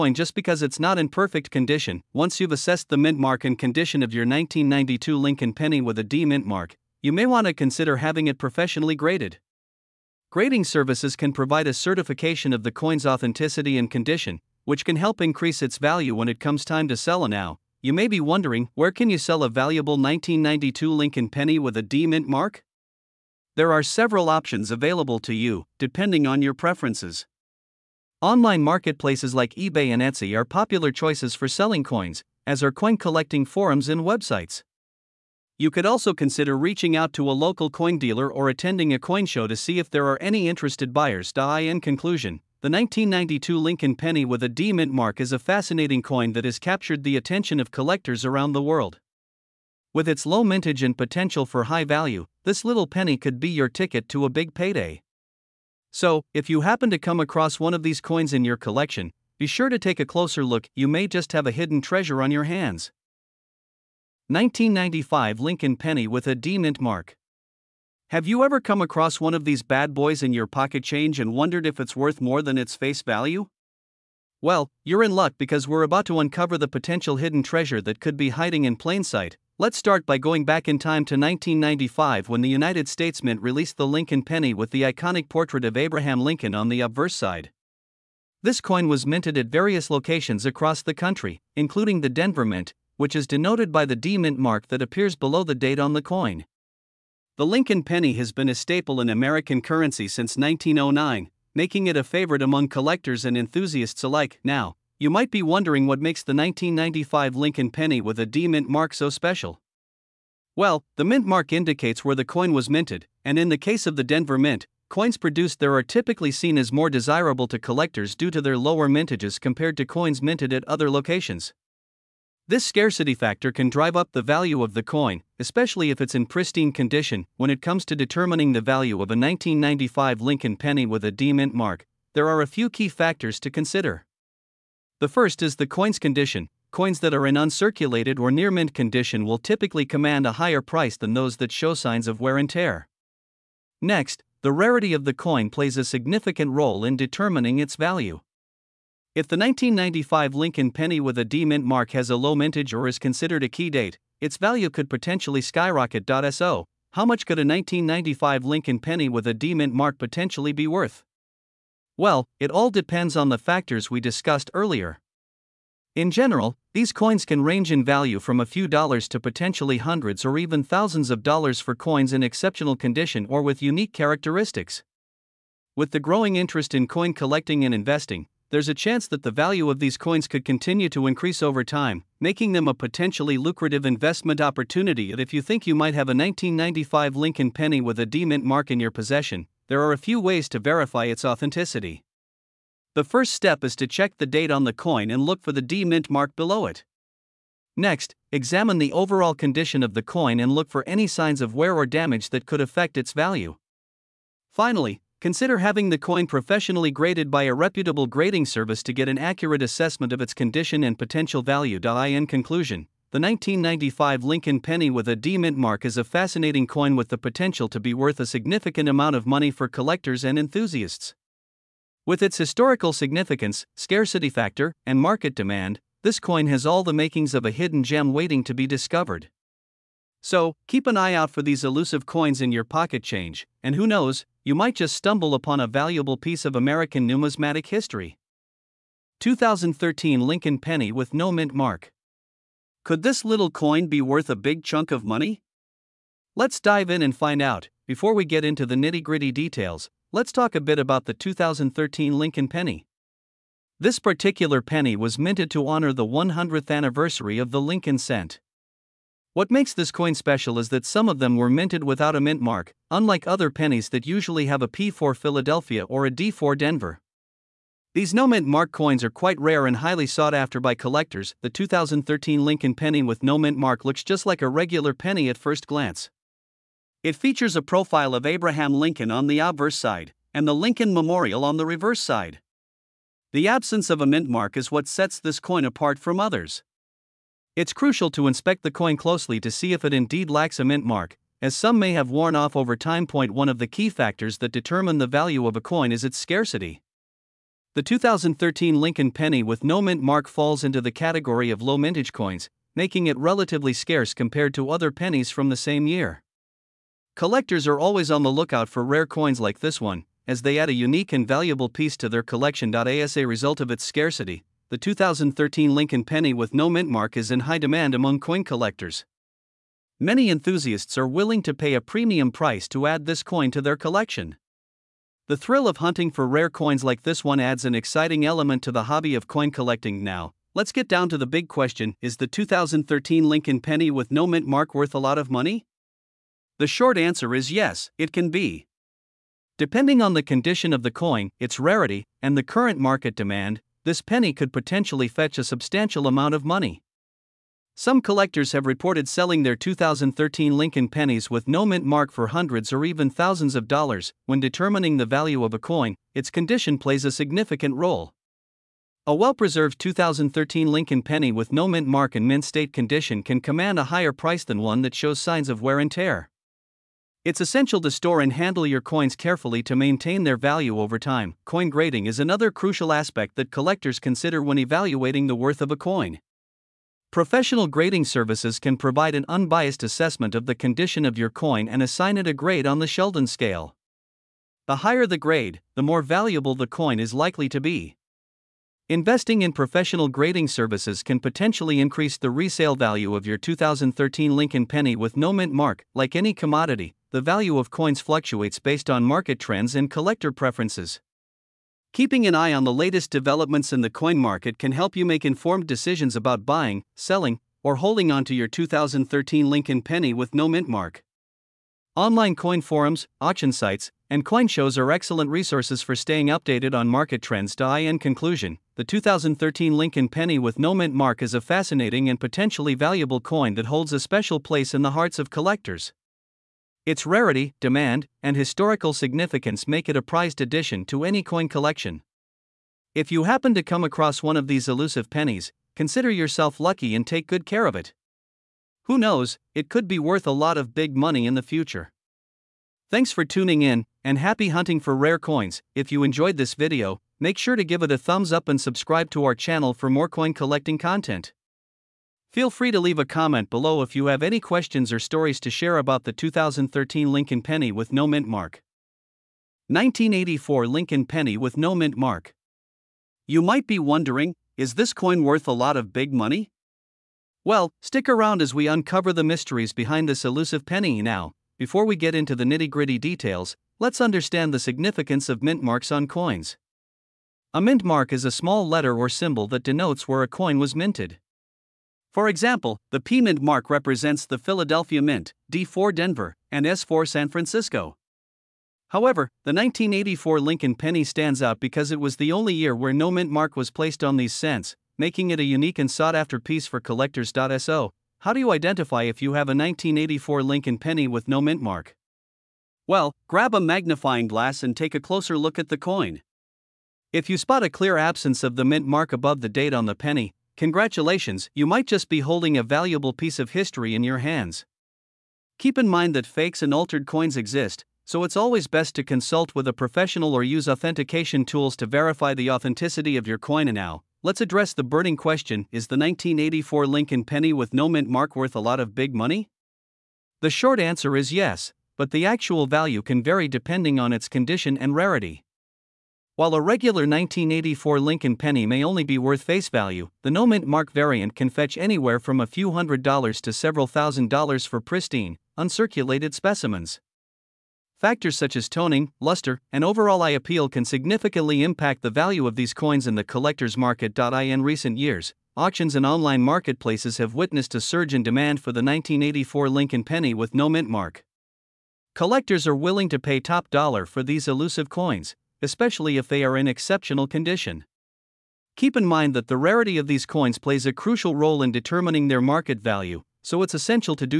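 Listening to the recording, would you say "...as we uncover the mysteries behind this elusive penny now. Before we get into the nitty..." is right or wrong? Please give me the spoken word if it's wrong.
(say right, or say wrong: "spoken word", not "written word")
right.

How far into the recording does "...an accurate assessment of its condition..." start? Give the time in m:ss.
3:29.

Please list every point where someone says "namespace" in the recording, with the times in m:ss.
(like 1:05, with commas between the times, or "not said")
not said.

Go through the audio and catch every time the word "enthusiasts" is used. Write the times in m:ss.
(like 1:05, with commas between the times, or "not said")
1:43, 3:40, 5:20.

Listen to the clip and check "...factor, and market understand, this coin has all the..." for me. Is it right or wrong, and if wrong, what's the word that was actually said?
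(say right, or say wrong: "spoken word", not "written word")
wrong: "demand", not "understand".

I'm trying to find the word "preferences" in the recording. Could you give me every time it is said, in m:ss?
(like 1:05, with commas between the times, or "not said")
0:26, 6:40.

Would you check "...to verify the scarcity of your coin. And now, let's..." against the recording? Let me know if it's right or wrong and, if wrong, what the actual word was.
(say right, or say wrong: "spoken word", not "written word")
wrong: "authenticity", not "scarcity".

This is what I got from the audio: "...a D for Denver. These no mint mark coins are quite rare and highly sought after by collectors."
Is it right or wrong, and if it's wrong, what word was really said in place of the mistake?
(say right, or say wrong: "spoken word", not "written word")
right.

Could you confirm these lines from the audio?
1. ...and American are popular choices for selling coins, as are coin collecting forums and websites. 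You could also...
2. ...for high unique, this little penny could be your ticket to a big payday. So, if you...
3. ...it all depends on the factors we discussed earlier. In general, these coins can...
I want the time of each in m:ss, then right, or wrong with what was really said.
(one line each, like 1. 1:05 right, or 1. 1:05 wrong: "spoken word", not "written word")
1. 0:29 wrong: "Etsy", not "American"
2. 0:51 wrong: "value", not "unique"
3. 2:42 right.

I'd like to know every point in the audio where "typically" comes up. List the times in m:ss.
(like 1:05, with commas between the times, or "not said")
1:55, 2:19.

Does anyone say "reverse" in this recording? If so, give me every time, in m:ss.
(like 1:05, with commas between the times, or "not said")
4:41.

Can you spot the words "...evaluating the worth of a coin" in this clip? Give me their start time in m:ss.
6:14.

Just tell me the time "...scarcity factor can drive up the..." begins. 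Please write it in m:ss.
2:02.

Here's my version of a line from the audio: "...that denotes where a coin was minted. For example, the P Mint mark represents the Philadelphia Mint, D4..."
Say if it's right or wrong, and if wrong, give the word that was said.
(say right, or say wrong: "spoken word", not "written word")
right.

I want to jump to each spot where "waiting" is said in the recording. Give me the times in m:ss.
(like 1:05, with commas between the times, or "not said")
3:48.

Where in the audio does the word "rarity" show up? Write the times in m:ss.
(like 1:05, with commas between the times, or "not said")
2:24, 5:41, 7:07, 8:54, 9:29.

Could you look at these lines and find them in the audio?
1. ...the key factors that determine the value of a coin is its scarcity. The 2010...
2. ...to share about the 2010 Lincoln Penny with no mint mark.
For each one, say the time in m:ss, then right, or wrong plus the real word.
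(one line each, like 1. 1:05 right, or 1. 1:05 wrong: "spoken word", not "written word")
1. 4:53 wrong: "2013", not "2010"
2. 7:35 wrong: "2013", not "2010".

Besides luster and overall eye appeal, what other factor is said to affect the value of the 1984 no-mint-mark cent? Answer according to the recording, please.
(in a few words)
Toning.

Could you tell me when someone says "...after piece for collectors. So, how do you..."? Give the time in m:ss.
8:16.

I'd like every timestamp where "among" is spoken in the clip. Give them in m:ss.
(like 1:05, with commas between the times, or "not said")
1:42, 5:17.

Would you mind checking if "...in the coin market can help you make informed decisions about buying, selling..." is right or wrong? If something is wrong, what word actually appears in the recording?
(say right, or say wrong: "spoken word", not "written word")
right.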